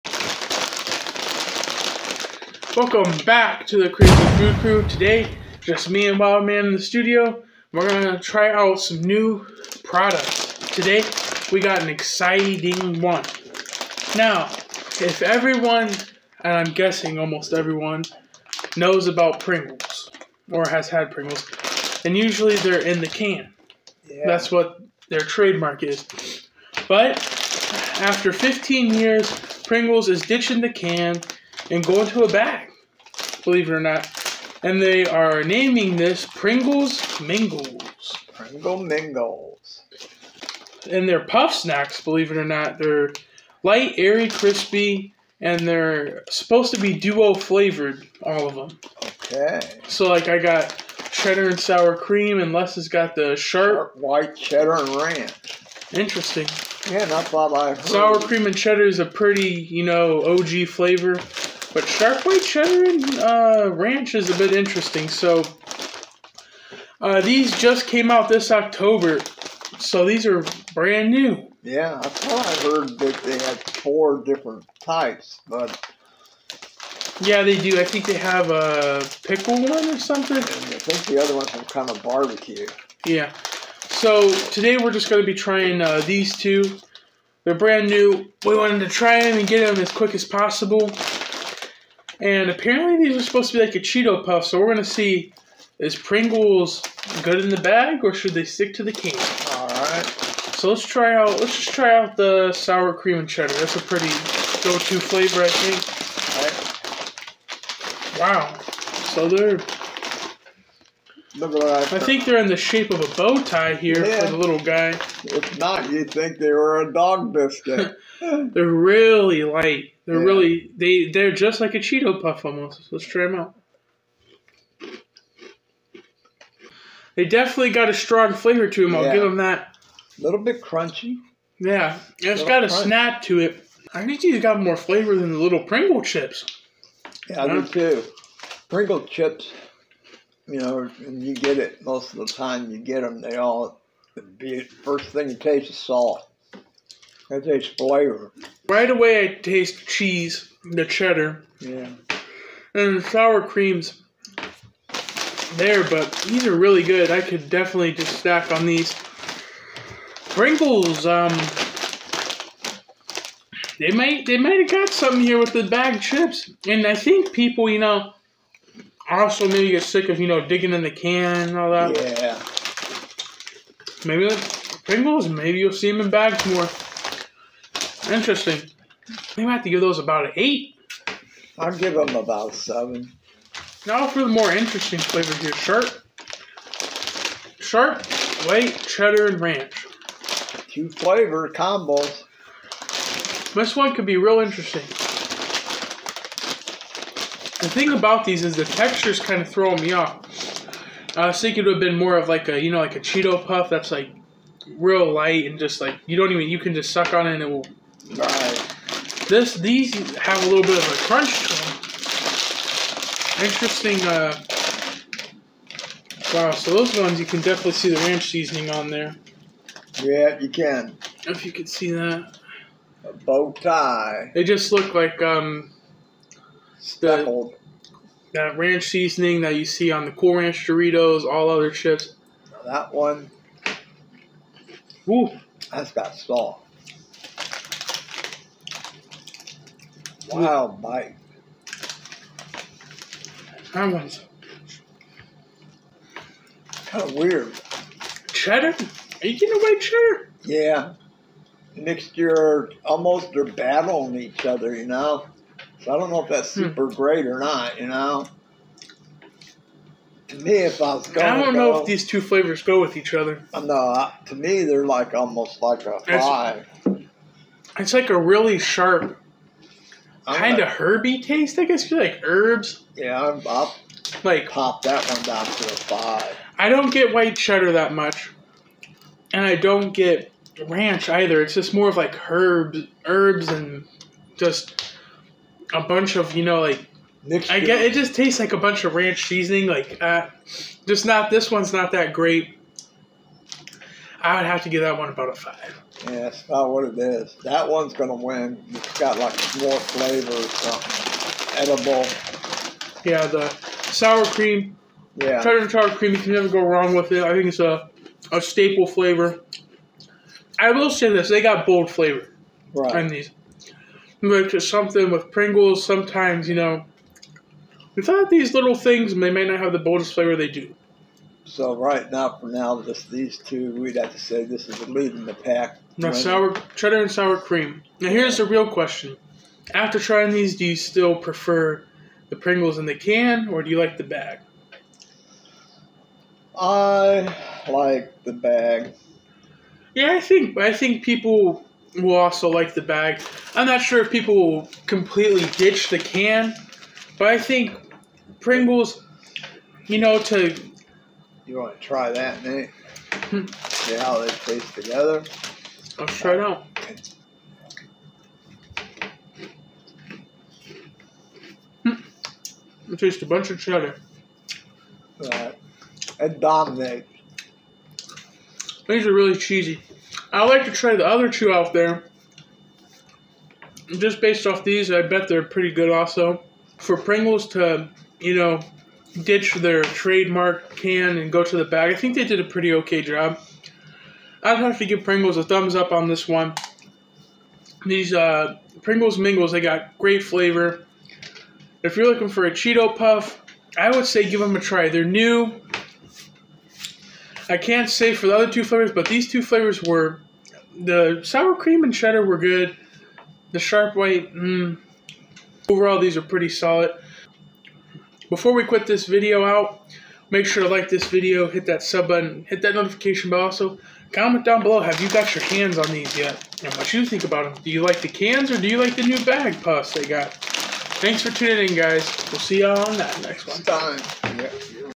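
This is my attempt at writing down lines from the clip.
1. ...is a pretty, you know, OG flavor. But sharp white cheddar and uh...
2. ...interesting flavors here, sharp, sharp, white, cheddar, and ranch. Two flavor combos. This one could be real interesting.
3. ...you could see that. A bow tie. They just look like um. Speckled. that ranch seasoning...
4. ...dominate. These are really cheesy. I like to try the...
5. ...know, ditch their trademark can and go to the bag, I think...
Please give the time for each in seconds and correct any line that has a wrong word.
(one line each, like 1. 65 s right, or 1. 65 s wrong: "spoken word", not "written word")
1. 58 s right
2. 184 s right
3. 221 s right
4. 366 s right
5. 378 s right.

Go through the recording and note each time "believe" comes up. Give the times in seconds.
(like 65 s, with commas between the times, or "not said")
33 s, 42 s.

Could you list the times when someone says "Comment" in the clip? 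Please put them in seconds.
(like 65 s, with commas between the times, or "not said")
414 s.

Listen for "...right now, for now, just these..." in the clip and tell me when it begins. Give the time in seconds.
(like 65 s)
321 s.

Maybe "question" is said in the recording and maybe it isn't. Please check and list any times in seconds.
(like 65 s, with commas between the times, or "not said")
328 s.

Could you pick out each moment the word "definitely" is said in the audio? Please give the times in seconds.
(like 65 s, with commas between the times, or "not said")
127 s, 157 s, 217 s.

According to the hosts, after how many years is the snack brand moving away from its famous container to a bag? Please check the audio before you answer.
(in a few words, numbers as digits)
15.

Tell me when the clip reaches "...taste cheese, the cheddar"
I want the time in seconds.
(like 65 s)
149 s.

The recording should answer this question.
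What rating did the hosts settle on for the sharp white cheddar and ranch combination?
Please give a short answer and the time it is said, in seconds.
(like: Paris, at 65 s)
5, at 295 s.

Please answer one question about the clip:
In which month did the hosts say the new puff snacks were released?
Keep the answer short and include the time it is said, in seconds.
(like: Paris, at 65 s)
October, at 68 s.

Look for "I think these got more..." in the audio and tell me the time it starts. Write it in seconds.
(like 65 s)
133 s.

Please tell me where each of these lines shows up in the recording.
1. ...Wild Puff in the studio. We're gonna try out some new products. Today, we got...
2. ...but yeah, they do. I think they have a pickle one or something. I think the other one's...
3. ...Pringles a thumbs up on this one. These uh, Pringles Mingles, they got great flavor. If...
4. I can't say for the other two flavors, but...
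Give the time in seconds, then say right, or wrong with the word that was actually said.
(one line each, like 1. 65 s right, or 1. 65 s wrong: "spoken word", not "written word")
1. 6 s wrong: "Man", not "Puff"
2. 75 s right
3. 385 s right
4. 397 s right.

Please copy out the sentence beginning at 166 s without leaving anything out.
And I think people, you know, also maybe get sick of, you know, digging in the can and all that.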